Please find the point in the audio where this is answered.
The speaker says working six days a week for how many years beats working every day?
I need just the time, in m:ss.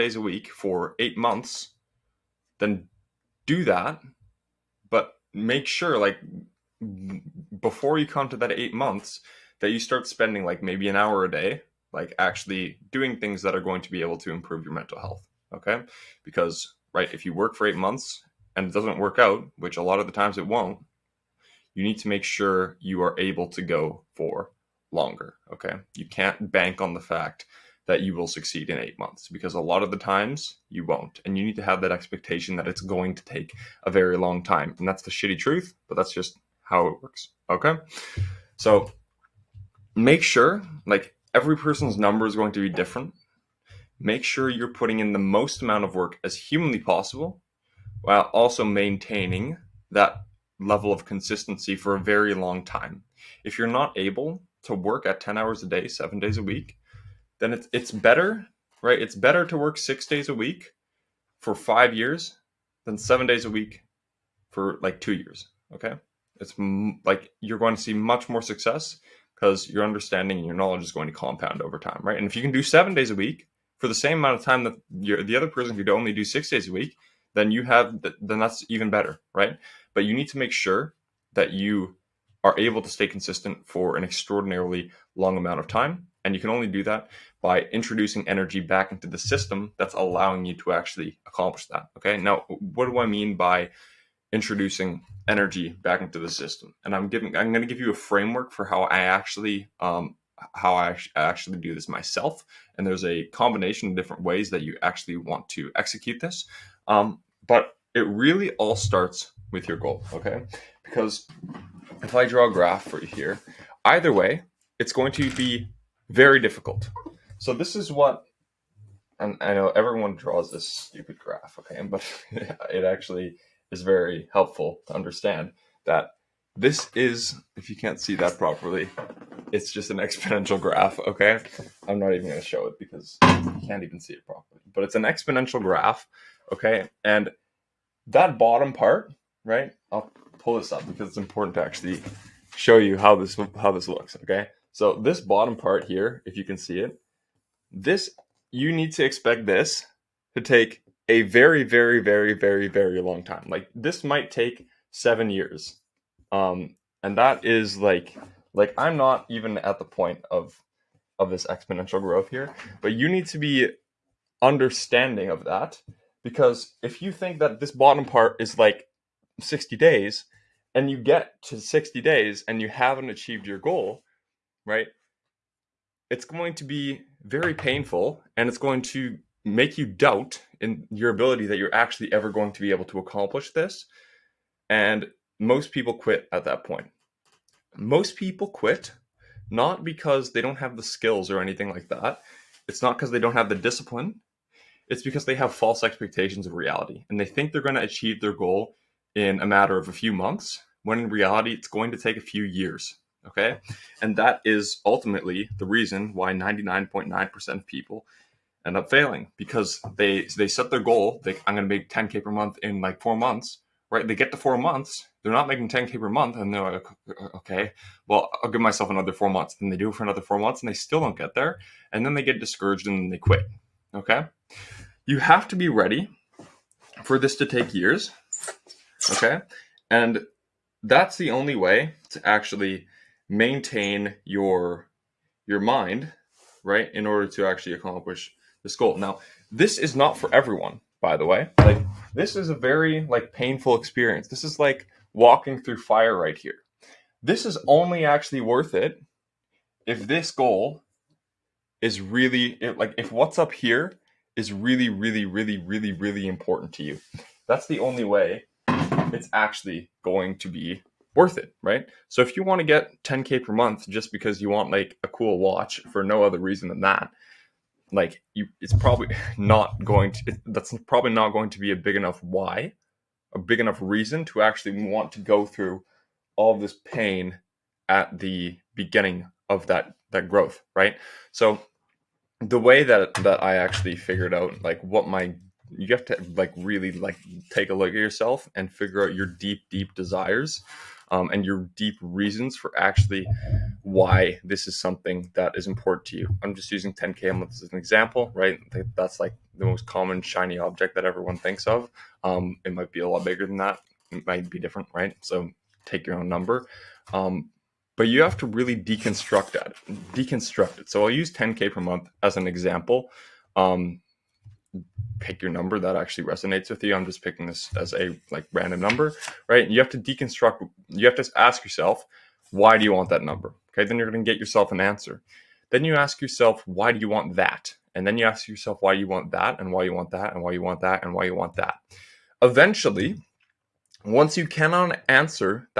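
1:01.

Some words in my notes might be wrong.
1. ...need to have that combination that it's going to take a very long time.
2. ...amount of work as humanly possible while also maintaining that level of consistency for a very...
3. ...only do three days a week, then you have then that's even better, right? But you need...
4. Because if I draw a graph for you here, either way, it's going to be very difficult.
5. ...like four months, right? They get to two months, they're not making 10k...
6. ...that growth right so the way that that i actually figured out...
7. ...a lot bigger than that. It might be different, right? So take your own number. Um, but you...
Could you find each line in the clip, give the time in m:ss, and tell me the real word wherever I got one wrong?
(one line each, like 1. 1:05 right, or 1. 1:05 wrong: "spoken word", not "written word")
1. 0:31 wrong: "expectation", not "combination"
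2. 0:45 right
3. 1:15 wrong: "six", not "three"
4. 1:50 right
5. 3:32 wrong: "four", not "two"
6. 4:40 right
7. 5:03 right.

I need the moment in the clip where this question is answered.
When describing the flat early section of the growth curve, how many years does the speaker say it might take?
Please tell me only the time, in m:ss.
2:34.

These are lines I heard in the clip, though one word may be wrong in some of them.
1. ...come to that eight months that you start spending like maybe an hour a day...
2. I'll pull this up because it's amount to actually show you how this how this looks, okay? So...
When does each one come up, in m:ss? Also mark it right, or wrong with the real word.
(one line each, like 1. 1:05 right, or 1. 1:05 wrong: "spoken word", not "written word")
1. 0:08 right
2. 2:19 wrong: "important", not "amount".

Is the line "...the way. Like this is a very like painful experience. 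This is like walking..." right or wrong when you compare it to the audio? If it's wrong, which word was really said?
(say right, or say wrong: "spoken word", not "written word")
right.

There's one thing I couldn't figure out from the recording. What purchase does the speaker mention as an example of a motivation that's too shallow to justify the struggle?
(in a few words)
a cool watch.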